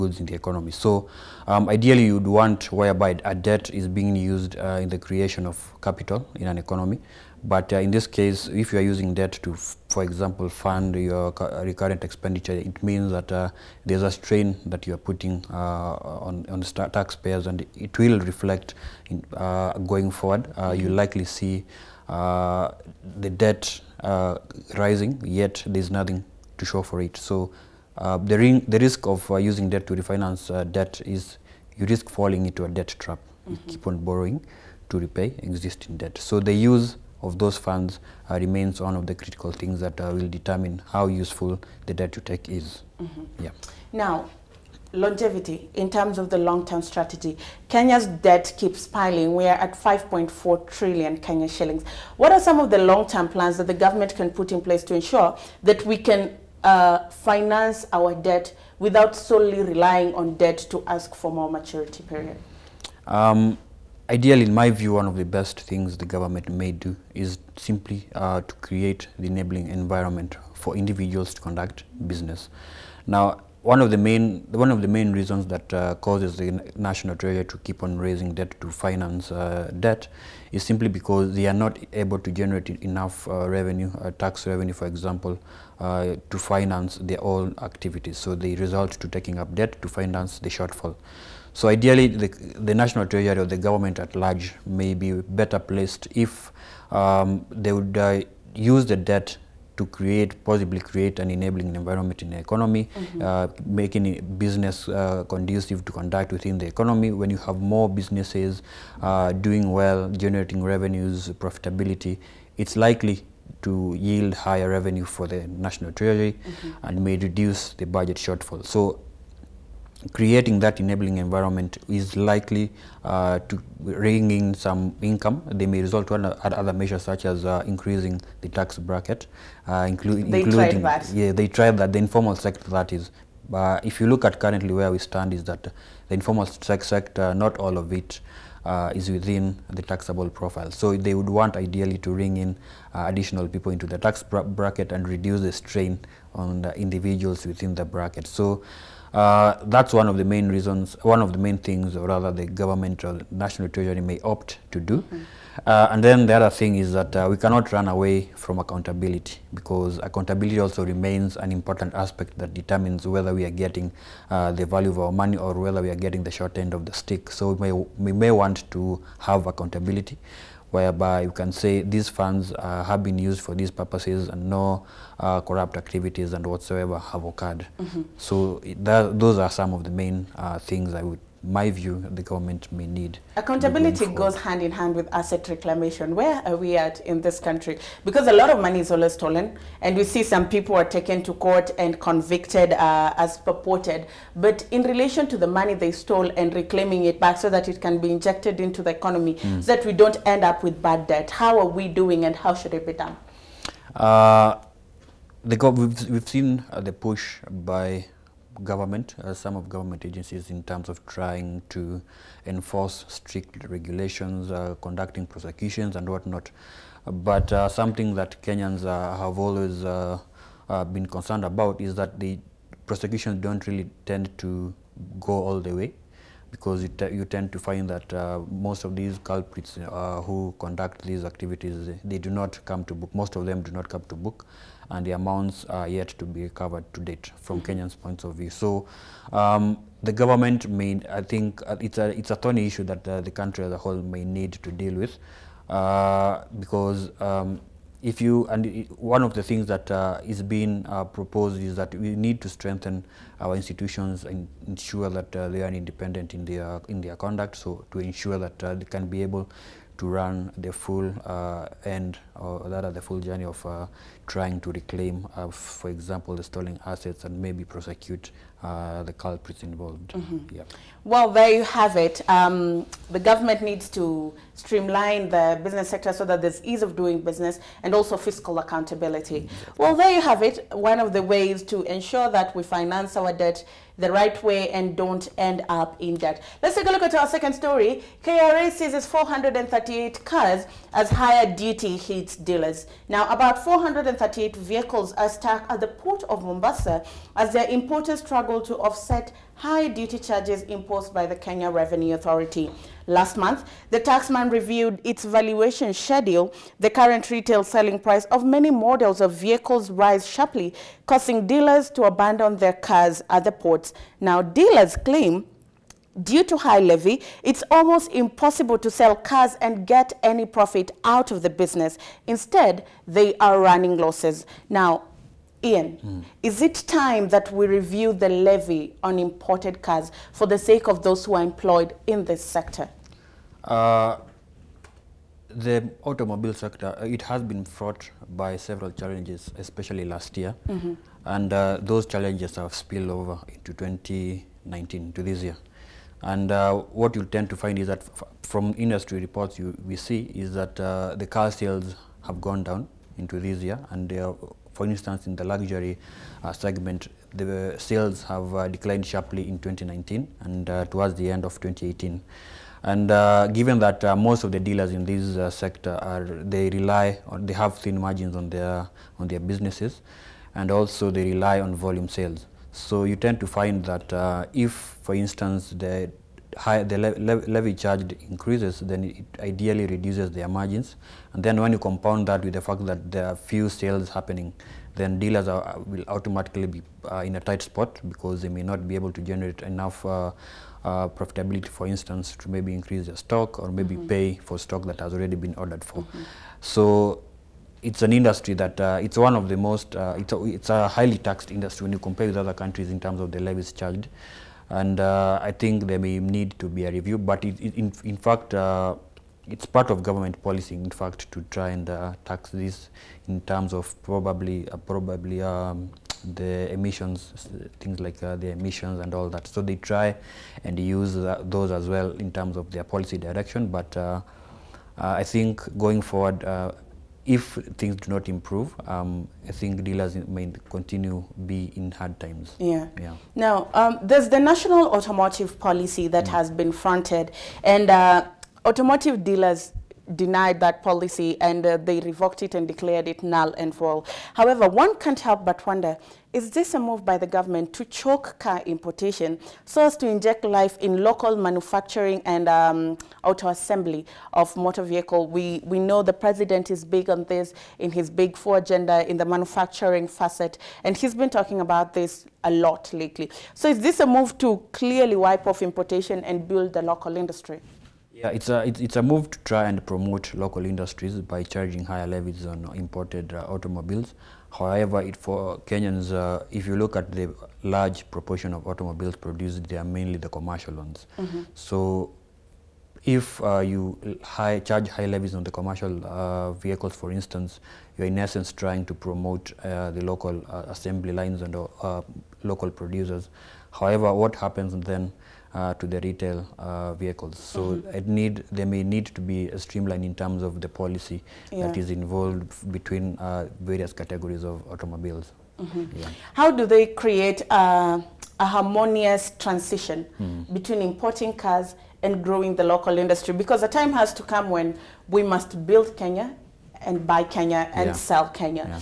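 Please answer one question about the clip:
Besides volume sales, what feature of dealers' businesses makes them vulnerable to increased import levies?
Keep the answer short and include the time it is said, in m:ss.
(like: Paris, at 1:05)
Thin margins, at 6:07.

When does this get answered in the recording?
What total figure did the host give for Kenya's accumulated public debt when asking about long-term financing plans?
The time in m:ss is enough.
0:49.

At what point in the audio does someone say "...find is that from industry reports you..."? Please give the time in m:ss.
5:47.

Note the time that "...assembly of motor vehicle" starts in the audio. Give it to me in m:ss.
7:33.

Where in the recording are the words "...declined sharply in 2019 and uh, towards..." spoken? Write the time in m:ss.
5:58.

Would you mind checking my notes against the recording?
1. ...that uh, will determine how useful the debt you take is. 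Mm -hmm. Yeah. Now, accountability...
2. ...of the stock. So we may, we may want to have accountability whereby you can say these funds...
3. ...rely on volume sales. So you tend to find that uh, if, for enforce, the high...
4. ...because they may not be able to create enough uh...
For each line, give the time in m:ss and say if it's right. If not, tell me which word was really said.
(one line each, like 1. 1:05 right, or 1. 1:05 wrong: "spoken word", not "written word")
1. 0:39 wrong: "longevity", not "accountability"
2. 2:46 wrong: "stick", not "stock"
3. 6:11 wrong: "instance", not "enforce"
4. 6:28 wrong: "generate", not "create".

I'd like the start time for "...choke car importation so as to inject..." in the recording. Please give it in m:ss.
7:27.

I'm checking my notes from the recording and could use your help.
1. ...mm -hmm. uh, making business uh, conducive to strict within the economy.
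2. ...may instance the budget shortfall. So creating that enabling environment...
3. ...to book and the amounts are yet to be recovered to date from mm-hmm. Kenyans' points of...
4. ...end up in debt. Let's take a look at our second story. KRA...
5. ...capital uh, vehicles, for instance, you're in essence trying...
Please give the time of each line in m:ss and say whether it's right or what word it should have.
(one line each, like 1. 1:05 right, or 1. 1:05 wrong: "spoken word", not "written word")
1. 1:42 wrong: "conduct", not "strict"
2. 1:56 wrong: "reduce", not "instance"
3. 3:54 right
4. 4:45 right
5. 8:05 wrong: "commercial", not "capital".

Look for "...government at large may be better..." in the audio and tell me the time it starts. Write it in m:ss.
1:33.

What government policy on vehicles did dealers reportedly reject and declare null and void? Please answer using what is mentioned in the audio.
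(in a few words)
National Automotive Policy.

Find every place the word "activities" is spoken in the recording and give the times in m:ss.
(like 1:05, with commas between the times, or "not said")
1:27, 2:55, 3:51.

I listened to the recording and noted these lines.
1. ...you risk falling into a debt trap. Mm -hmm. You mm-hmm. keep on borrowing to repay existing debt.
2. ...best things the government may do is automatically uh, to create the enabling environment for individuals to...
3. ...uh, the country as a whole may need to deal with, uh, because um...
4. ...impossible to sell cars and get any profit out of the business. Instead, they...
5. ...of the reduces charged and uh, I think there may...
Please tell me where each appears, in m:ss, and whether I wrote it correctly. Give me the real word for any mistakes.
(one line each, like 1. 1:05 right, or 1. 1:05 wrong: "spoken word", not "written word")
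1. 0:31 right
2. 1:05 wrong: "simply", not "automatically"
3. 4:03 right
4. 5:18 right
5. 6:43 wrong: "levies", not "reduces".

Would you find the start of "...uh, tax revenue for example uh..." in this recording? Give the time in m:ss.
1:24.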